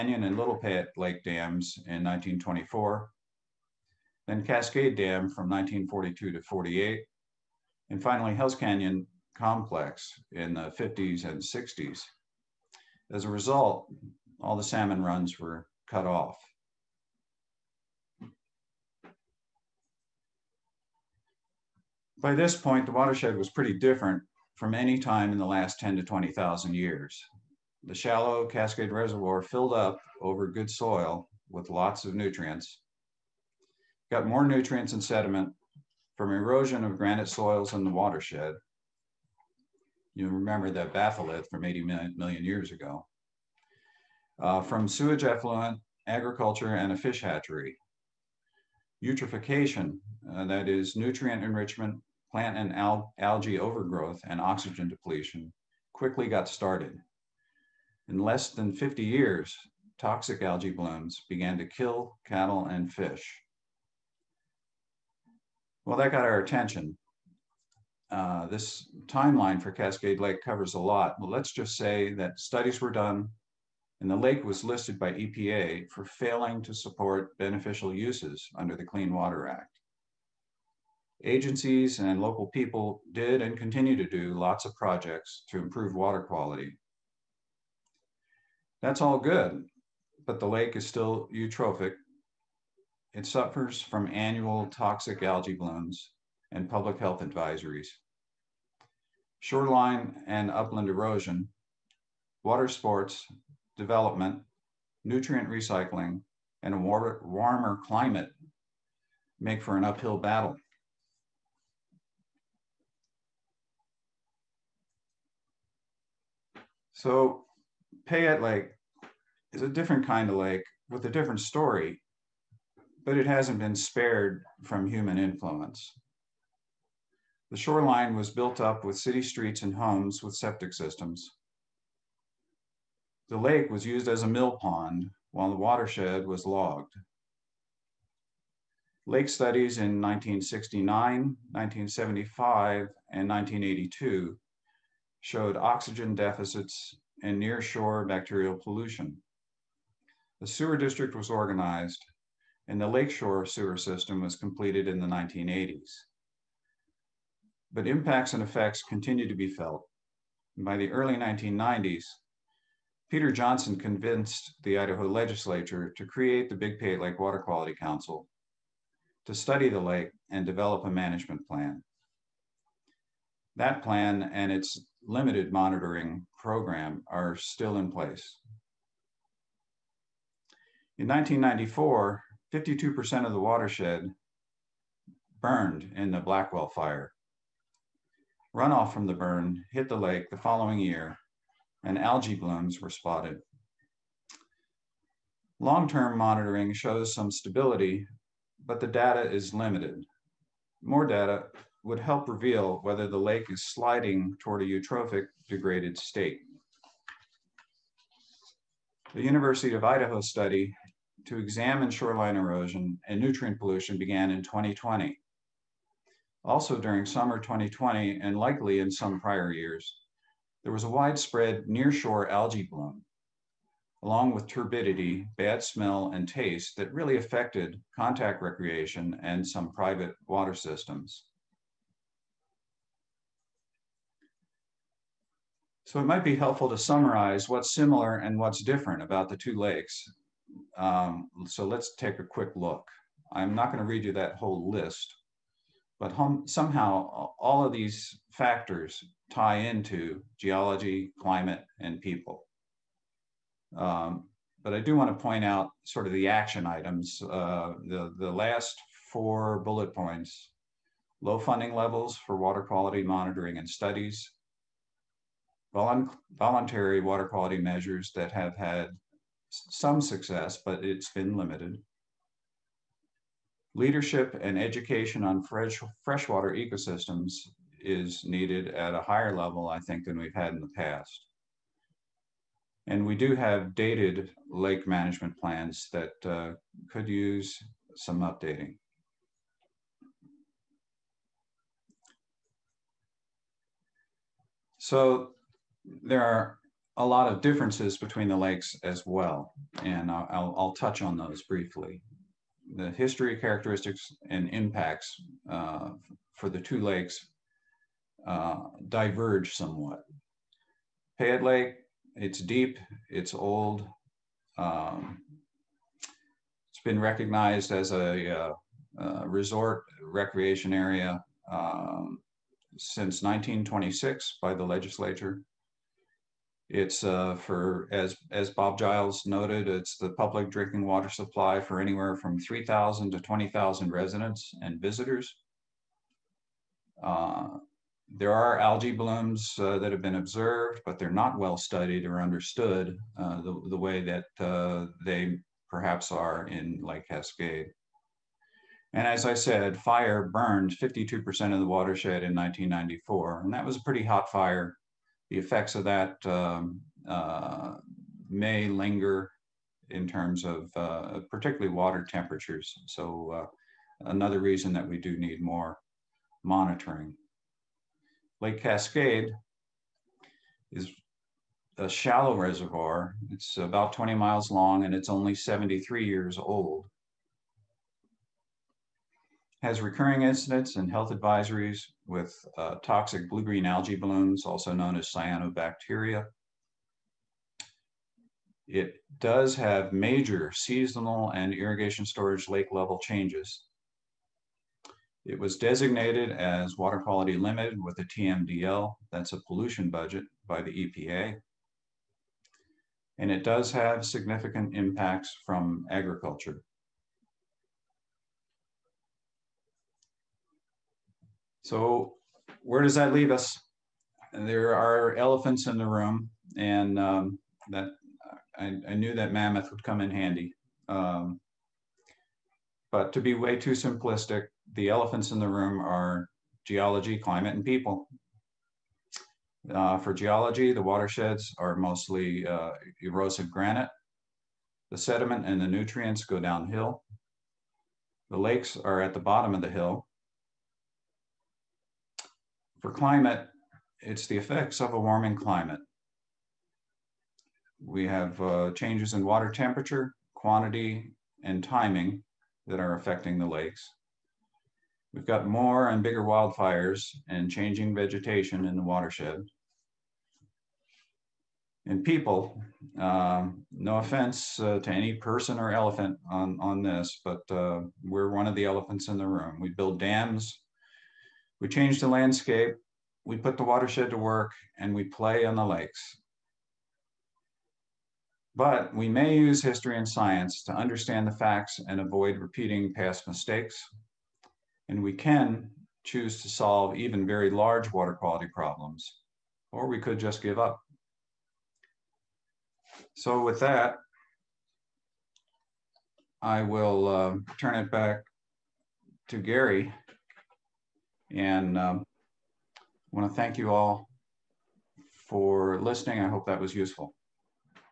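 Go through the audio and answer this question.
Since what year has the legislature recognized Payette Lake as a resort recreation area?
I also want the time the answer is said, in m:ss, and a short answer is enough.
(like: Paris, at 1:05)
1926, at 5:23.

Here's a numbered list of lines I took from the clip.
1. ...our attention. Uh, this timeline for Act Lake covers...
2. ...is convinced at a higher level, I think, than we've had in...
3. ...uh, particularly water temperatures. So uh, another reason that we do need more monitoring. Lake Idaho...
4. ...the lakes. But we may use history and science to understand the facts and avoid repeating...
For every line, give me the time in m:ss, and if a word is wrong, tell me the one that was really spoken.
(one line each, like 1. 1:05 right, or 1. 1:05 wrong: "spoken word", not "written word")
1. 1:06 wrong: "Cascade", not "Act"
2. 4:37 wrong: "needed", not "convinced"
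3. 6:00 wrong: "Cascade", not "Idaho"
4. 7:55 right.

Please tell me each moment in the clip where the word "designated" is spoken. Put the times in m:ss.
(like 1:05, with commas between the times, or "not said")
6:35.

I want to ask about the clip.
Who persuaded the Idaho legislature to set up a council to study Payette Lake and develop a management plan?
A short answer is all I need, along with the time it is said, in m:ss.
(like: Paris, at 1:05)
Peter Johnson, at 2:43.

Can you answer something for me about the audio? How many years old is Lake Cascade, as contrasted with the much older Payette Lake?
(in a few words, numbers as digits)
73.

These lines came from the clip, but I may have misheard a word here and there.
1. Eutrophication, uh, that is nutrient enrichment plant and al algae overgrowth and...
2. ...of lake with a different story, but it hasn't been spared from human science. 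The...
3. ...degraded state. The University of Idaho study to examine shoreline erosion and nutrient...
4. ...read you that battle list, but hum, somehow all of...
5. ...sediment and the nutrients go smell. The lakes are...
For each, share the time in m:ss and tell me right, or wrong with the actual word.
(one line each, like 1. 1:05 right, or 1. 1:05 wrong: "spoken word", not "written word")
1. 0:49 right
2. 2:00 wrong: "influence", not "science"
3. 3:25 right
4. 4:03 wrong: "whole", not "battle"
5. 7:14 wrong: "downhill", not "smell".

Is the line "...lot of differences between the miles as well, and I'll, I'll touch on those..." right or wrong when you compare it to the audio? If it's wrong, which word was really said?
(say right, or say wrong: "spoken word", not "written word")
wrong: "lakes", not "miles".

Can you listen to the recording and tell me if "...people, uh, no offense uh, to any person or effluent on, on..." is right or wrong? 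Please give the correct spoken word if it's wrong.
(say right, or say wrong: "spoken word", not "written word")
wrong: "elephant", not "effluent".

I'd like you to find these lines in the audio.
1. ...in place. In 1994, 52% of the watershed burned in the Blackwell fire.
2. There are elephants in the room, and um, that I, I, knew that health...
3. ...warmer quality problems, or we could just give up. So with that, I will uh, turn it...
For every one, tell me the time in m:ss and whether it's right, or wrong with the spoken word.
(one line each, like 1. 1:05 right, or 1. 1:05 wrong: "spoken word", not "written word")
1. 2:57 right
2. 6:54 wrong: "mammoth", not "health"
3. 8:07 wrong: "water", not "warmer".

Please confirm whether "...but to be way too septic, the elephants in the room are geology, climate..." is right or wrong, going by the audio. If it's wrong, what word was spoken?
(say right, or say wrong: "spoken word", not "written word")
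wrong: "simplistic", not "septic".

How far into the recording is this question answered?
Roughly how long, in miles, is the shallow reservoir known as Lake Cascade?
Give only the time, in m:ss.
6:13.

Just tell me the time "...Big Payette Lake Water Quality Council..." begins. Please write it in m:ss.
2:46.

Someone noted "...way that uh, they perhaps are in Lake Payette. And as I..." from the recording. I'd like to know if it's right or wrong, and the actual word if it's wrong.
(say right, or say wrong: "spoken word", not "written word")
wrong: "Cascade", not "Payette".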